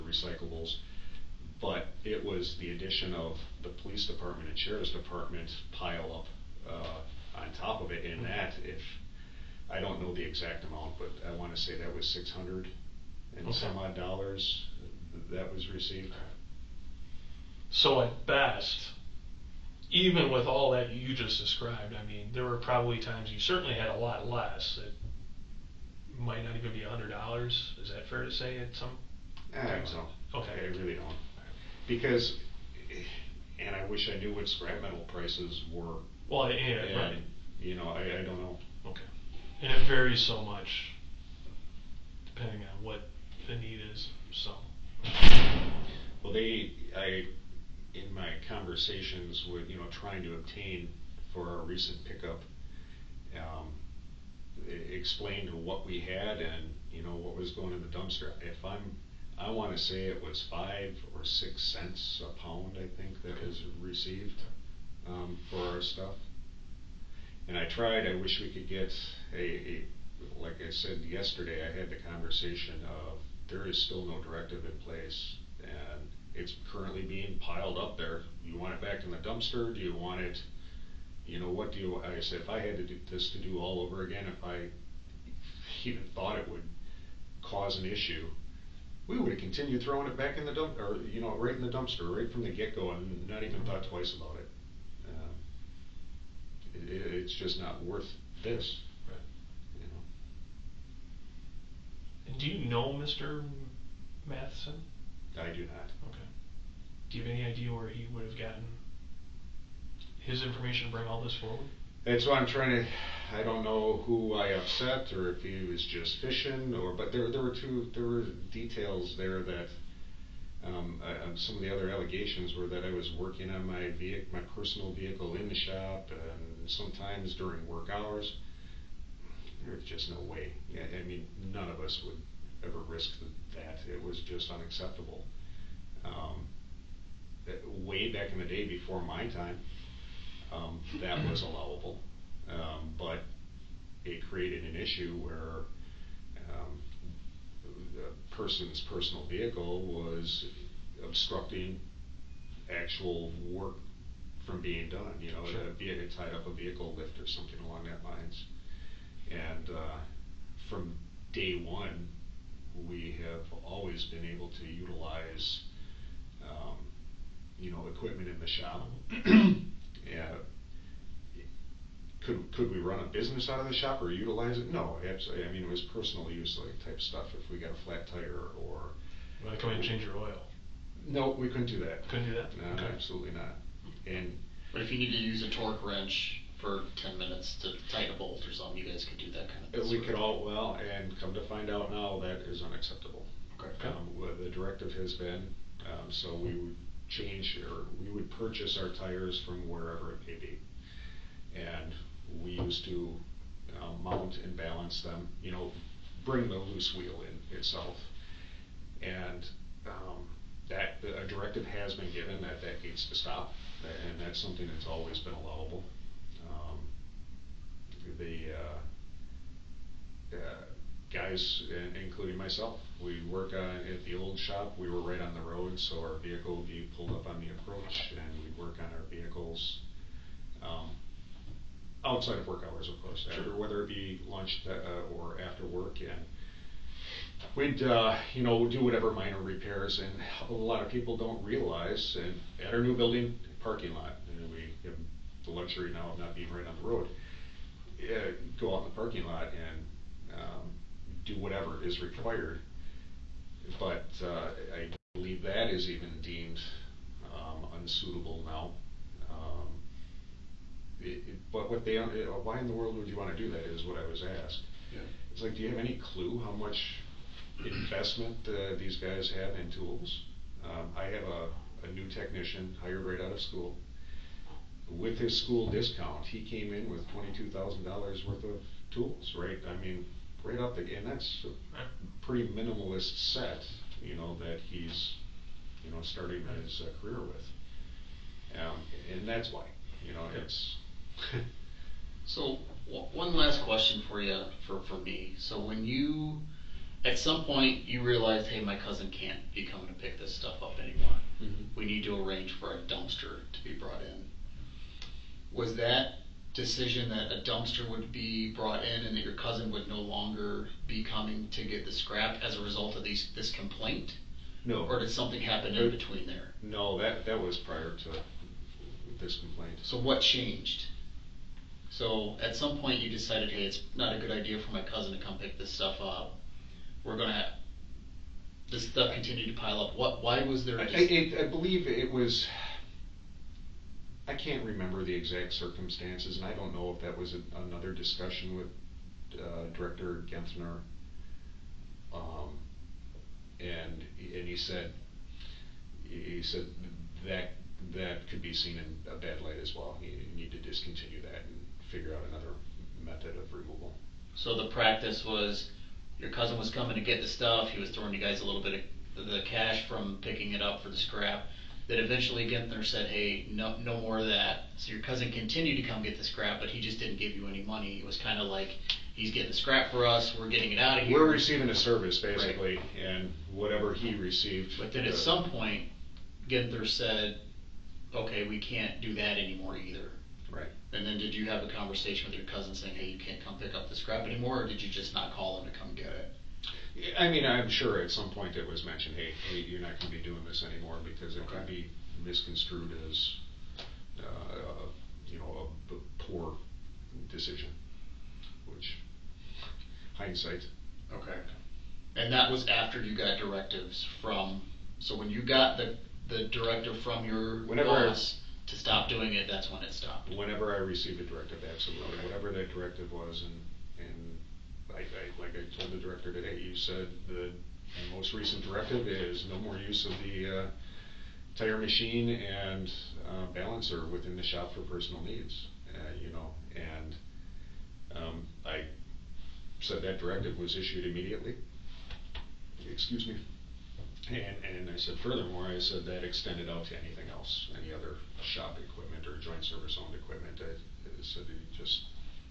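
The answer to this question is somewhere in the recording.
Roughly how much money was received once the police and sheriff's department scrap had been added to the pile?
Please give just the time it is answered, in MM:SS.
00:12.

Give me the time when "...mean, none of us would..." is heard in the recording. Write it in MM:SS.
02:11.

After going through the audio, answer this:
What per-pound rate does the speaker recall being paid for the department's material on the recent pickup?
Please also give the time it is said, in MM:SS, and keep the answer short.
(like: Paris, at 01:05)
5 or 6 cents, at 01:00.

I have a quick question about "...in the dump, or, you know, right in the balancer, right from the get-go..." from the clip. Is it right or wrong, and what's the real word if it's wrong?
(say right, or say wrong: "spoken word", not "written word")
wrong: "dumpster", not "balancer".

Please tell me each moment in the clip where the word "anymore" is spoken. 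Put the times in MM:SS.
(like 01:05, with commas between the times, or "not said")
05:00, 06:19, 06:24, 06:30.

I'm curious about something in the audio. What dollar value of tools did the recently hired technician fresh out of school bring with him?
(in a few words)
$22,000.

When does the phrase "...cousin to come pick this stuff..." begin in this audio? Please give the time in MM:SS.
05:24.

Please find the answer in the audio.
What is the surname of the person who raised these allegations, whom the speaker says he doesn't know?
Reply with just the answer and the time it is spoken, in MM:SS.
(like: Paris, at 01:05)
Matheson, at 01:44.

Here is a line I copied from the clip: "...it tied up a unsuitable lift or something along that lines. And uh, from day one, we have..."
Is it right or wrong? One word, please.
wrong.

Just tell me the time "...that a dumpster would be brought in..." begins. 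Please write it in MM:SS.
05:07.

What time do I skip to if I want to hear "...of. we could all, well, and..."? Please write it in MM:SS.
03:09.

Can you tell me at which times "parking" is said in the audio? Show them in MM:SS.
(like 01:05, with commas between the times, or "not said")
04:03, 04:08.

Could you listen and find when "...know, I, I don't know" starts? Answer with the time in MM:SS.
00:37.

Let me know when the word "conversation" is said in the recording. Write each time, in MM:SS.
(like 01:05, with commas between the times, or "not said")
00:48, 01:12, 06:21.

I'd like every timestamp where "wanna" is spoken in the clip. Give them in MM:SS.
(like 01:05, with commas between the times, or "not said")
00:11, 00:59.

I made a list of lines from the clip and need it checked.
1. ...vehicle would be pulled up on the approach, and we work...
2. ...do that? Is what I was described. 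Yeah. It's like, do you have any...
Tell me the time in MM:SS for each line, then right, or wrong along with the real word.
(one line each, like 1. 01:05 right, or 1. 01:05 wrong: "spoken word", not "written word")
1. 03:46 right
2. 04:23 wrong: "asked", not "described".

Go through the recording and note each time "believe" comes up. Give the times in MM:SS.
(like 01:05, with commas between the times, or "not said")
04:15, 05:31.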